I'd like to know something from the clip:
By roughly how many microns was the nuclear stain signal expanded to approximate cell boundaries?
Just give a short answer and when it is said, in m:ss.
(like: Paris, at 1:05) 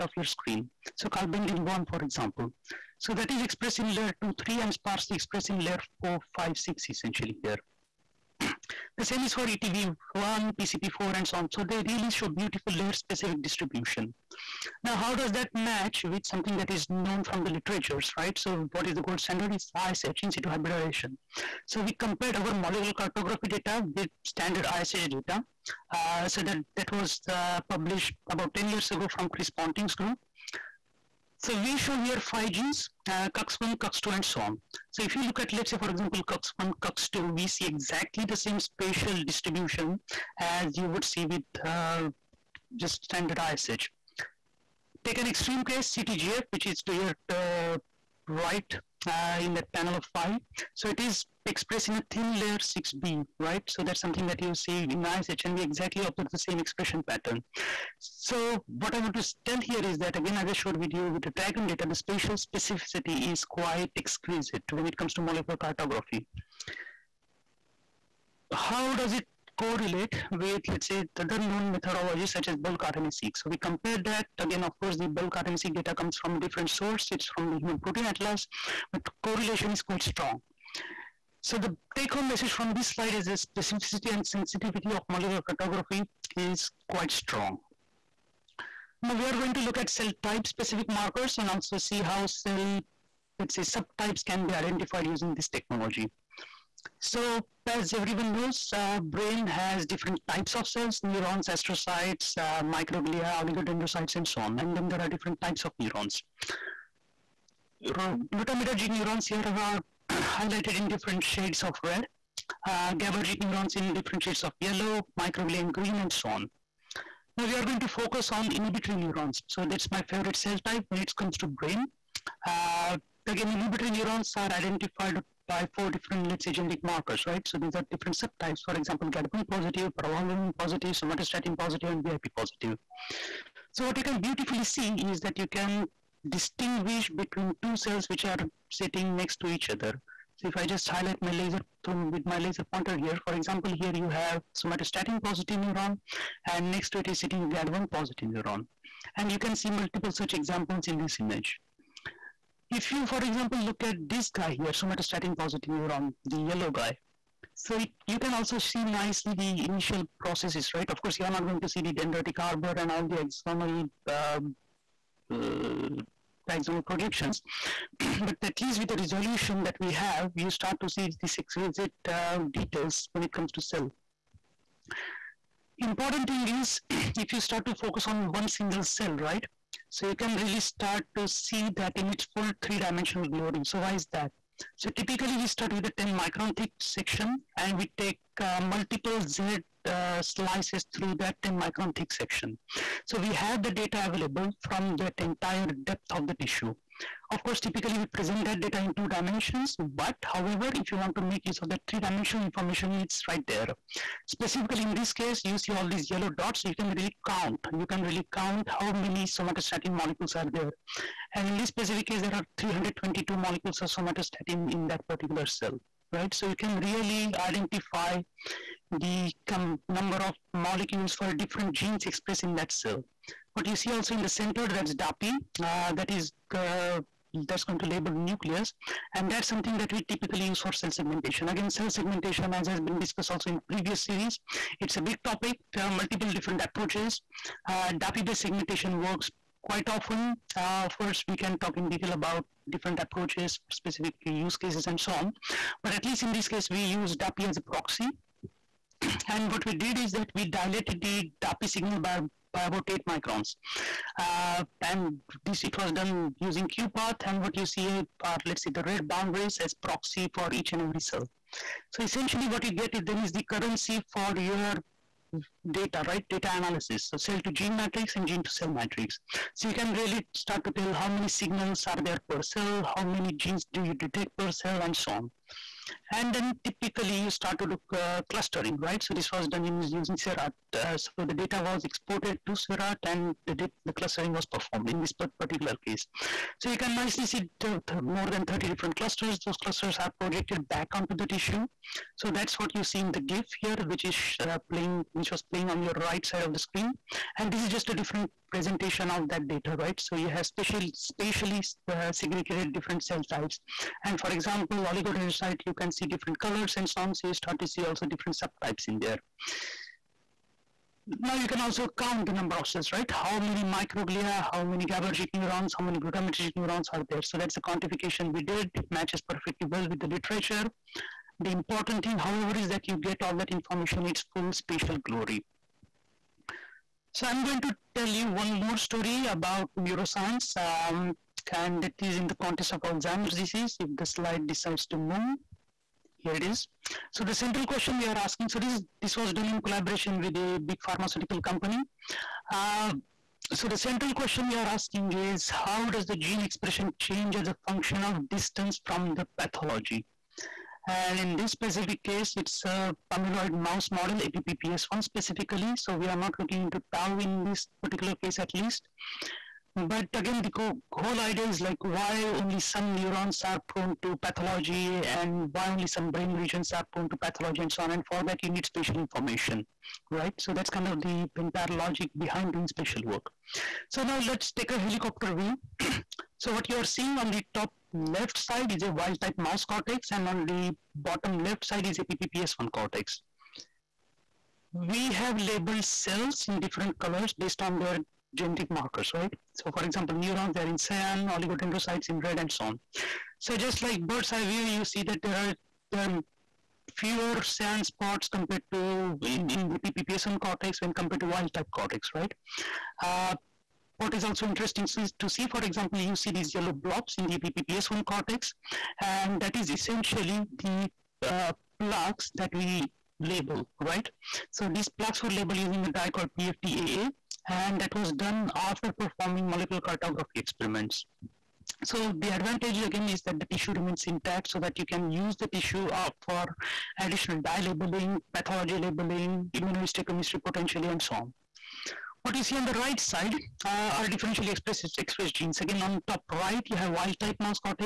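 8, at 4:12.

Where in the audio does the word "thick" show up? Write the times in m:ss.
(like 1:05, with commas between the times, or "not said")
3:06, 3:11.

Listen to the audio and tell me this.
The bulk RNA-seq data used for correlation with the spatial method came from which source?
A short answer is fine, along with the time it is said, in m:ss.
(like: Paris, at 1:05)
Human Protein Atlas, at 1:17.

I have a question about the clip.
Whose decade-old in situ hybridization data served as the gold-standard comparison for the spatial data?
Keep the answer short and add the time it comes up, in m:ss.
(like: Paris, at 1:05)
Chris Ponting's group, at 0:29.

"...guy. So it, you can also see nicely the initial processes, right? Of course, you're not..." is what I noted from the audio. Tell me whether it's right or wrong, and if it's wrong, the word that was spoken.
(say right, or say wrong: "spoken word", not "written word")
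right.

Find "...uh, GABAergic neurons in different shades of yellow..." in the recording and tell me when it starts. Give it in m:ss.
1:52.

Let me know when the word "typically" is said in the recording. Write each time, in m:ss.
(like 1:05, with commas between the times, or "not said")
3:04, 3:17, 3:50, 4:36.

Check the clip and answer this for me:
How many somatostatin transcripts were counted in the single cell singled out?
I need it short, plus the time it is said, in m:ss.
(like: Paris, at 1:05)
322, at 3:32.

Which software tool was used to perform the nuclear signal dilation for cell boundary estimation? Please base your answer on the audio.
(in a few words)
QuPath.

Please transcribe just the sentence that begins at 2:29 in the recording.
And you can see multiple such examples in this image.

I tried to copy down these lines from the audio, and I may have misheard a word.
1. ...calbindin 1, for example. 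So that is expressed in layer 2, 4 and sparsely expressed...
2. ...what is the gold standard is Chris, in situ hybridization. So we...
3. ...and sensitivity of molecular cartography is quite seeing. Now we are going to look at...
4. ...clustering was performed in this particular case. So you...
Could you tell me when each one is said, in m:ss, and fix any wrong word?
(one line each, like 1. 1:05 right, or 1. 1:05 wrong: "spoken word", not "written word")
1. 0:01 wrong: "3", not "4"
2. 0:18 wrong: "ISH", not "Chris"
3. 1:24 wrong: "strong", not "seeing"
4. 4:43 right.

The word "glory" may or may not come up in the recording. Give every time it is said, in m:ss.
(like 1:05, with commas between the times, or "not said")
3:03, 5:25.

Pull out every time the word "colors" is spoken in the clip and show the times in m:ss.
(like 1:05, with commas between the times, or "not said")
5:06, 6:26.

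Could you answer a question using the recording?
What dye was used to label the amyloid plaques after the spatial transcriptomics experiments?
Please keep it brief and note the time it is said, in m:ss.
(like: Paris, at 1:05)
PFTAA, at 6:56.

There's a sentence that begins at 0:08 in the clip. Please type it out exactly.
The same is for ETV1, PCP4, and so on.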